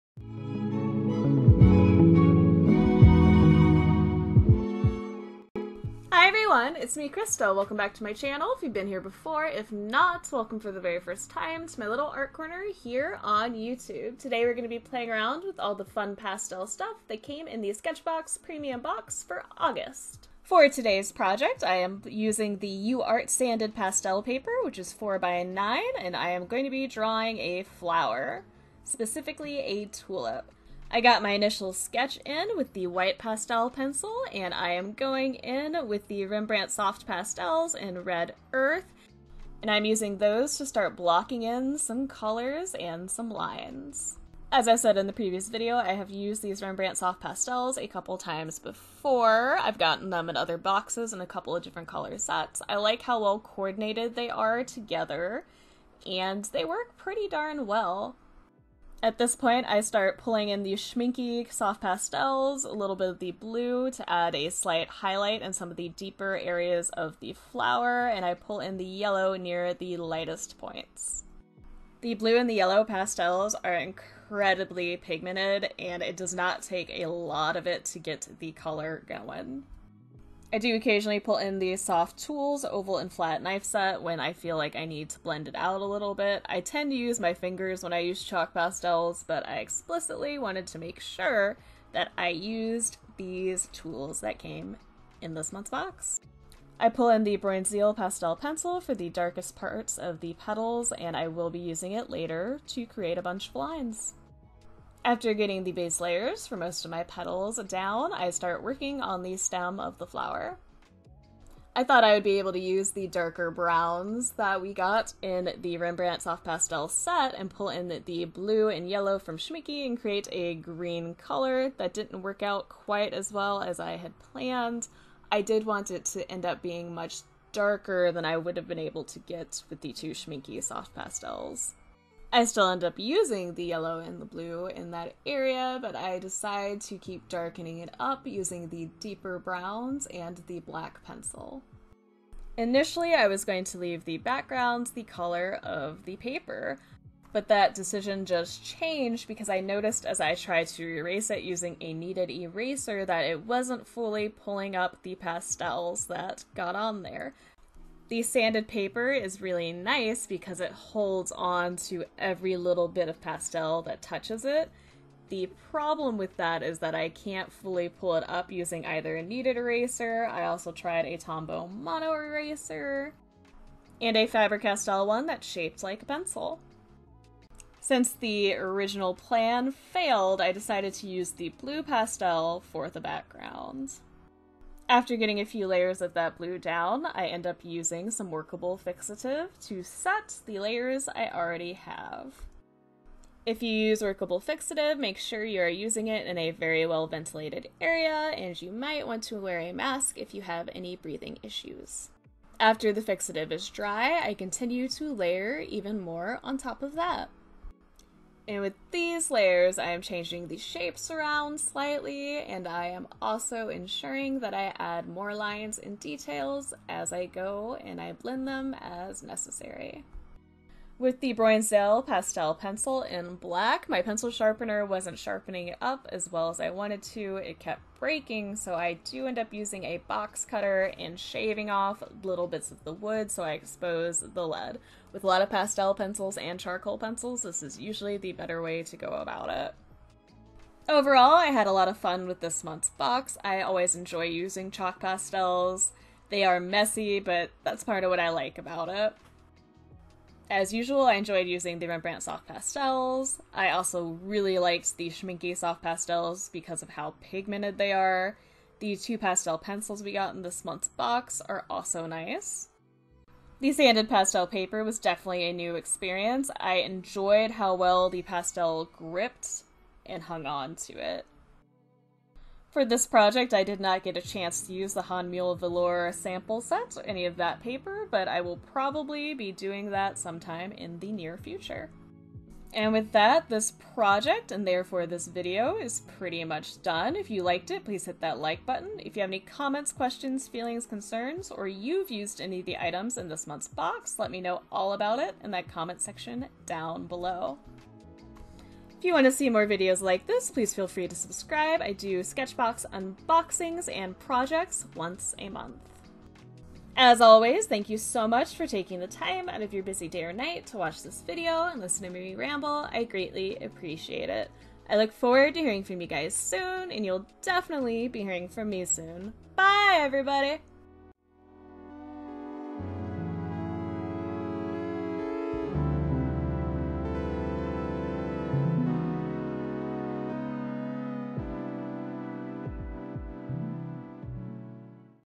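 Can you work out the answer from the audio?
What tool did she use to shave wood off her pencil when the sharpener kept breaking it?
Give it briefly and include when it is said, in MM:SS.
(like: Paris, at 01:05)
Box cutter, at 03:50.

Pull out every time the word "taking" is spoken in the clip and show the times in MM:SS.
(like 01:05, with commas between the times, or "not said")
05:08.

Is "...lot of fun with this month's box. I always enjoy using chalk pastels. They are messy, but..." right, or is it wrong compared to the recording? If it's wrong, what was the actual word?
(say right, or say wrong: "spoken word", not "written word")
right.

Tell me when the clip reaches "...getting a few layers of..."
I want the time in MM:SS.
03:05.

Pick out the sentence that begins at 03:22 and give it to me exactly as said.
After the fixative is dry, I continue to layer even more on top of that.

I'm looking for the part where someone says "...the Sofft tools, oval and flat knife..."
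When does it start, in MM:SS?
01:21.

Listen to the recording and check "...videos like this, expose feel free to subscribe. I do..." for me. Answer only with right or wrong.
wrong.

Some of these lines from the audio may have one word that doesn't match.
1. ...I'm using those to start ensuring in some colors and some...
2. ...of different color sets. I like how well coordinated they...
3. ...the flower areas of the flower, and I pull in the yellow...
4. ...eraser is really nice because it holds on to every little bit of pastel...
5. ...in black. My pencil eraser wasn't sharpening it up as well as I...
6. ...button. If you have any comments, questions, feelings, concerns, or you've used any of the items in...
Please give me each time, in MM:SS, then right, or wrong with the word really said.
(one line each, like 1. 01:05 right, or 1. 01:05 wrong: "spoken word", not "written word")
1. 00:39 wrong: "blocking", not "ensuring"
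2. 00:51 right
3. 01:05 wrong: "deeper", not "flower"
4. 02:38 wrong: "paper", not "eraser"
5. 03:43 wrong: "sharpener", not "eraser"
6. 04:48 right.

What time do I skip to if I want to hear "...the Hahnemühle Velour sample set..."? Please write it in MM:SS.
04:34.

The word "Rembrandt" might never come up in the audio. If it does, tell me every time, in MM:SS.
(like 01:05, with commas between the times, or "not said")
00:36, 00:46, 01:55, 04:11.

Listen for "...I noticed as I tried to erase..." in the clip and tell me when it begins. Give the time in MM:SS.
02:29.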